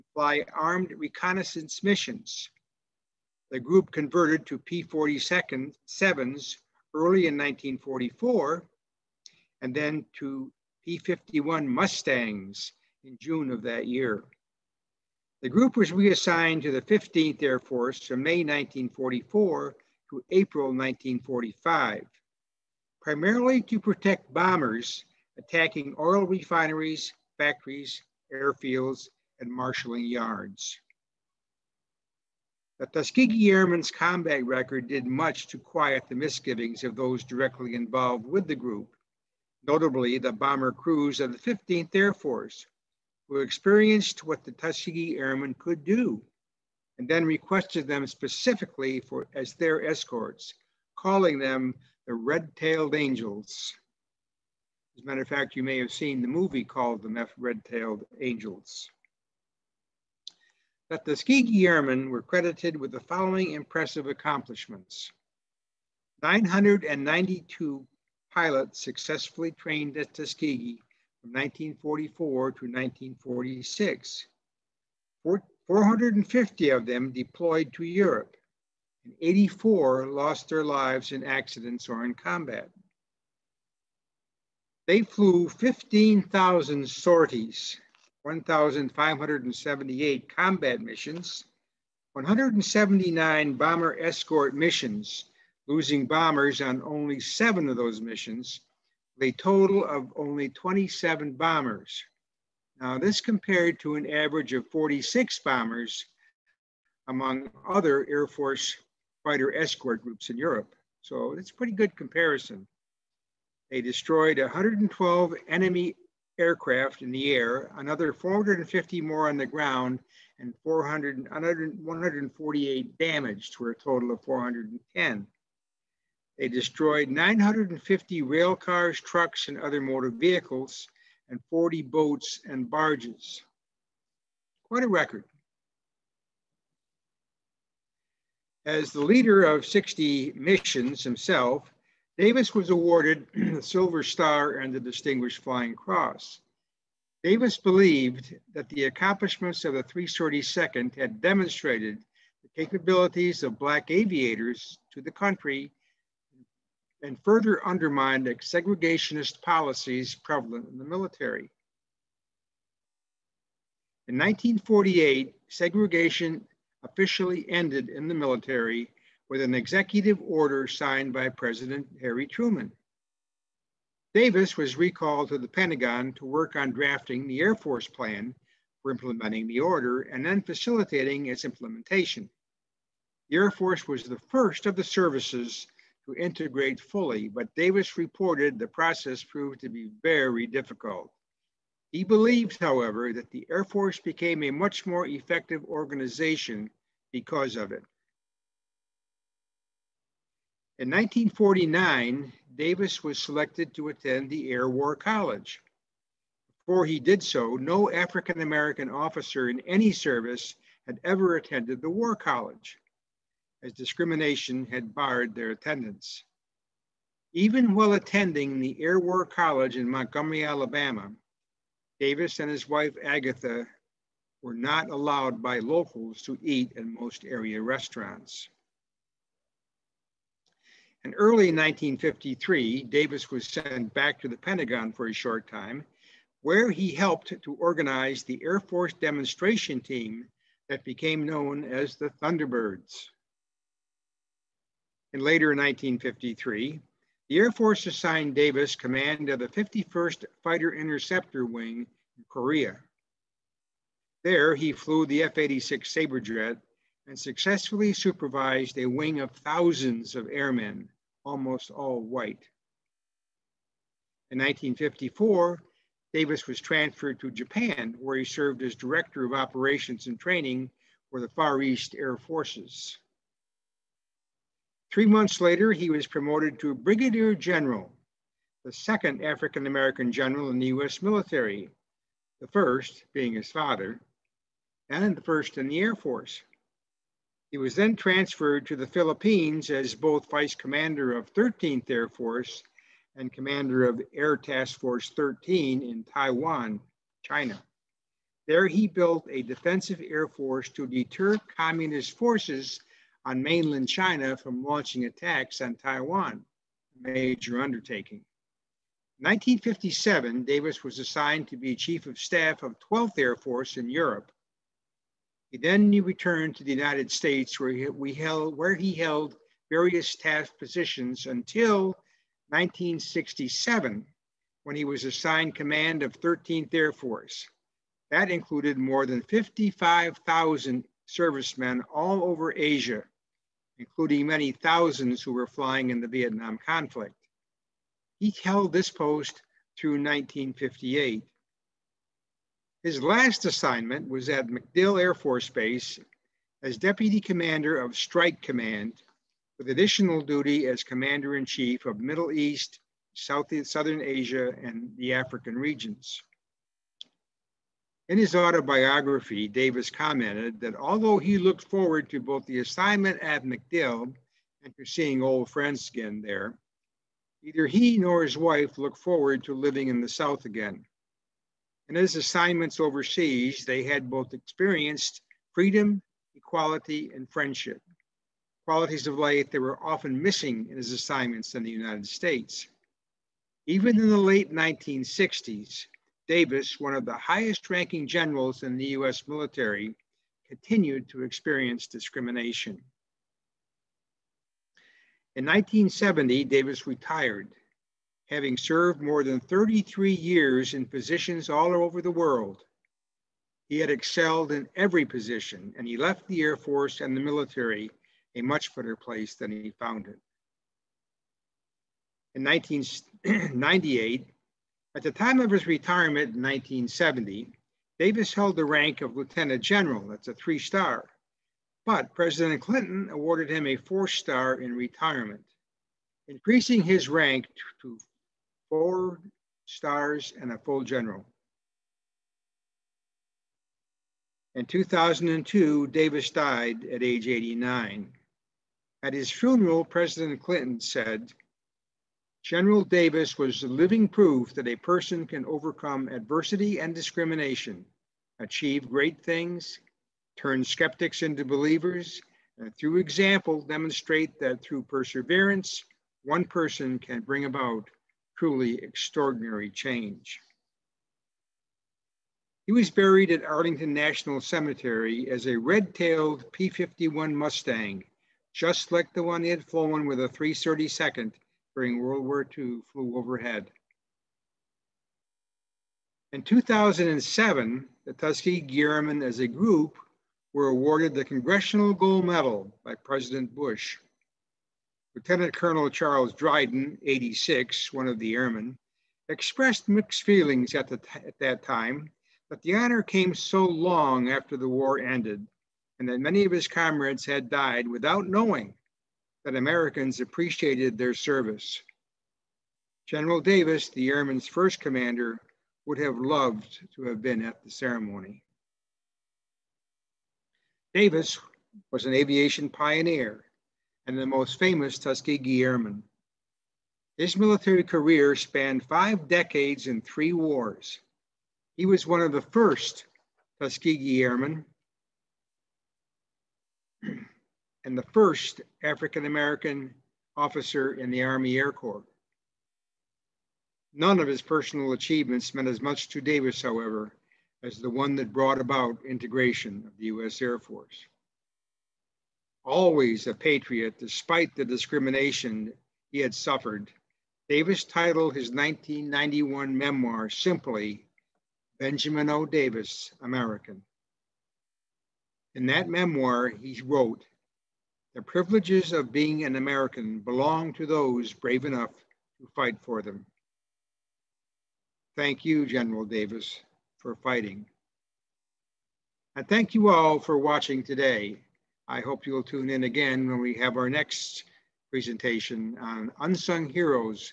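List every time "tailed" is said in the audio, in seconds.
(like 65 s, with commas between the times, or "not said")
52 s, 57 s, 465 s.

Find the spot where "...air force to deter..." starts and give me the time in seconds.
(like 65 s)
300 s.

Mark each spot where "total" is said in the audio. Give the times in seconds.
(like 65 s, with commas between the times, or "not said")
99 s, 123 s.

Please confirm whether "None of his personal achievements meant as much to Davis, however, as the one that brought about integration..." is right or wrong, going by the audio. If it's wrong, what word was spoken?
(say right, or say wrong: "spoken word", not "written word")
right.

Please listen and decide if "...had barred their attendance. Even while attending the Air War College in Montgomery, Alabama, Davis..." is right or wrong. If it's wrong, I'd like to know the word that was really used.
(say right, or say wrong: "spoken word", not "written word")
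right.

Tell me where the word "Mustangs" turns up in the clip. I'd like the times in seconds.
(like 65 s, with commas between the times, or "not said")
11 s, 467 s.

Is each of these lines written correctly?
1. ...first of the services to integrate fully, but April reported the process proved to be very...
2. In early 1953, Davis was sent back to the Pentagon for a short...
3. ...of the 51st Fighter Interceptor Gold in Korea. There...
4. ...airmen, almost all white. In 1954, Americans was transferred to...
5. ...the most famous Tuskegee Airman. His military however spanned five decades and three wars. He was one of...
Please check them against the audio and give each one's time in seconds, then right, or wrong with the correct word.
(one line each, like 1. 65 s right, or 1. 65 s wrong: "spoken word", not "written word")
1. 184 s wrong: "Davis", not "April"
2. 231 s right
3. 249 s wrong: "Wing", not "Gold"
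4. 260 s wrong: "Davis", not "Americans"
5. 514 s wrong: "career", not "however".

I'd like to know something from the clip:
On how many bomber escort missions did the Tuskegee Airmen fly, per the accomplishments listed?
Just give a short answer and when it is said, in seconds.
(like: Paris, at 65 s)
179, at 92 s.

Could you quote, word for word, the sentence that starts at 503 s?
General Davis, the airmen's first commander, would have loved to have been at the ceremony.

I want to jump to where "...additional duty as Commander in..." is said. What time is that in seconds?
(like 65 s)
349 s.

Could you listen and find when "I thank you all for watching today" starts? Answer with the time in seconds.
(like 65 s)
569 s.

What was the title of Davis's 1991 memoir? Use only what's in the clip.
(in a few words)
Benjamin O. Davis, American.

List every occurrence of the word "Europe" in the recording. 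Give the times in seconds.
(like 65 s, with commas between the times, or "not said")
77 s, 110 s, 313 s.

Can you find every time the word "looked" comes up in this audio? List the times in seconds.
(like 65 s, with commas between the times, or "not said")
361 s, 368 s.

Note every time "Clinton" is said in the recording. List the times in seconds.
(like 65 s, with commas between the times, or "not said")
422 s, 440 s.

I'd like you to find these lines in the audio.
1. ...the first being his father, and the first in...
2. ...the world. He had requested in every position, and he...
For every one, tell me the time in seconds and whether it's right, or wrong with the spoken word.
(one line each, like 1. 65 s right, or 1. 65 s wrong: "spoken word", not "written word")
1. 282 s right
2. 401 s wrong: "excelled", not "requested".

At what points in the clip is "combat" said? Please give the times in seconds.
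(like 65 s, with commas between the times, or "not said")
33 s, 82 s, 90 s.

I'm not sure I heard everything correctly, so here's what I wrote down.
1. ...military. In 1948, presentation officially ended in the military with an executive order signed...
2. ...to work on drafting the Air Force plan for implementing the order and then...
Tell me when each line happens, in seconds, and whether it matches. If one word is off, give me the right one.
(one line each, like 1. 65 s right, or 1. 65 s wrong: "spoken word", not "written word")
1. 160 s wrong: "segregation", not "presentation"
2. 176 s right.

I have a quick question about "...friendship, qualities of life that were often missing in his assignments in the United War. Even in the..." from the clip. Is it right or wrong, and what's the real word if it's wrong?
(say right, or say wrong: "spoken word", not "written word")
wrong: "States", not "War".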